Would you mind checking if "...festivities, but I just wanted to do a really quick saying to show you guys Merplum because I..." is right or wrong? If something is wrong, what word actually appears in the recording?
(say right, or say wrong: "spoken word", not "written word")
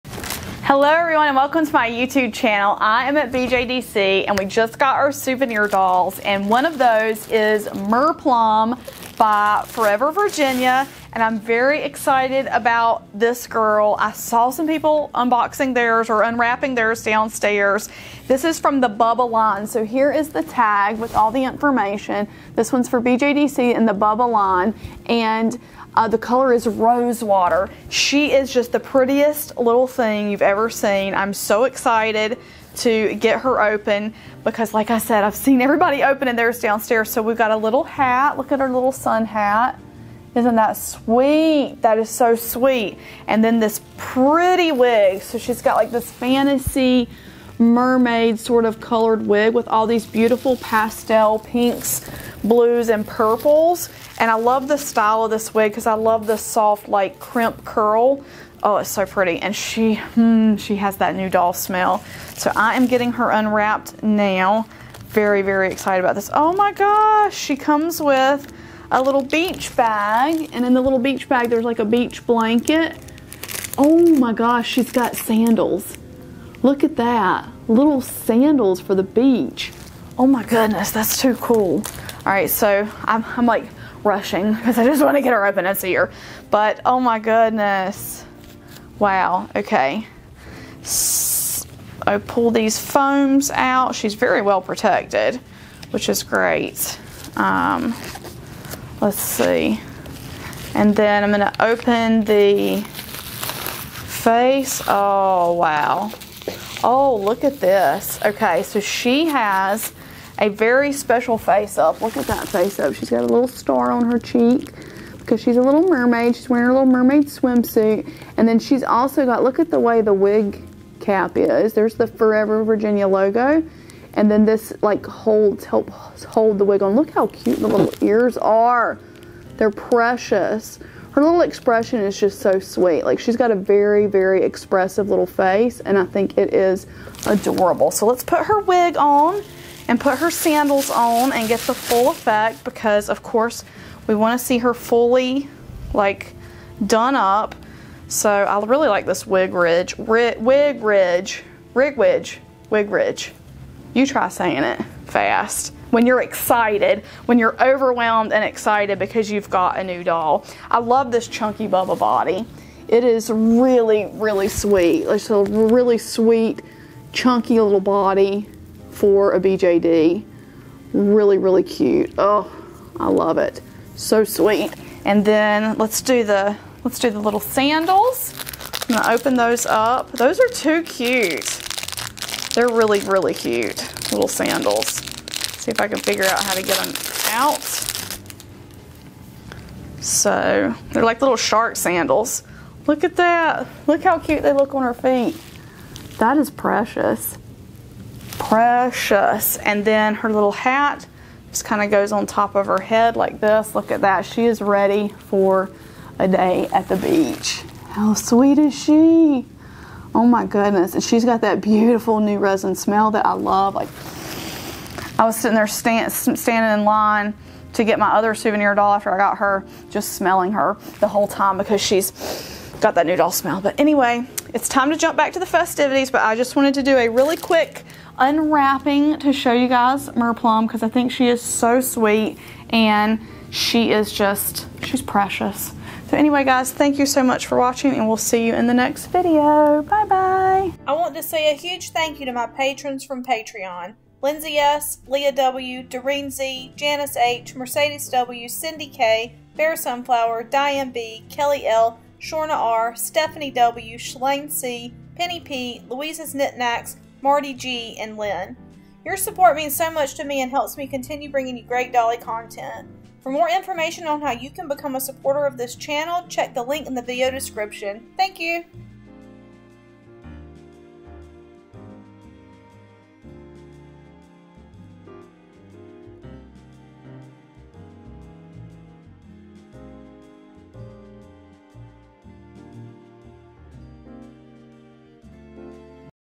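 wrong: "unwrapping", not "saying".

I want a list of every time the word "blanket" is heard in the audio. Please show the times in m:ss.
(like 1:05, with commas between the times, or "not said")
1:12.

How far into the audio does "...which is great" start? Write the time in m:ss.
1:35.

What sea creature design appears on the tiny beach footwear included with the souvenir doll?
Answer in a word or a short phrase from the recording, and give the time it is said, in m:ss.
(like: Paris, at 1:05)
Shark, at 3:11.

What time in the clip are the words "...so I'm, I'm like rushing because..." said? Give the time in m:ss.
1:22.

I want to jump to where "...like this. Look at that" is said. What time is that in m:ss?
3:23.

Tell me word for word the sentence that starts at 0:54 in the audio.
And I love the style of this wig because I love the soft like crimp curl.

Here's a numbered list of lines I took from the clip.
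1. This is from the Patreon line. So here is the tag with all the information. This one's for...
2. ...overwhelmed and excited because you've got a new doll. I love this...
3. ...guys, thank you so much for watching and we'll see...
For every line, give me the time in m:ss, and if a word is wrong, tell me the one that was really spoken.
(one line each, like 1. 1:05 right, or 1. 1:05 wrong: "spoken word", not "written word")
1. 0:18 wrong: "Bubba", not "Patreon"
2. 2:37 right
3. 3:56 right.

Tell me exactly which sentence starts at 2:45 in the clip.
It's a really sweet, chunky little body for a BJD.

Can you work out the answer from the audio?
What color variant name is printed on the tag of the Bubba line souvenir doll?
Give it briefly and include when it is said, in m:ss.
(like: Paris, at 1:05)
Rose water, at 0:26.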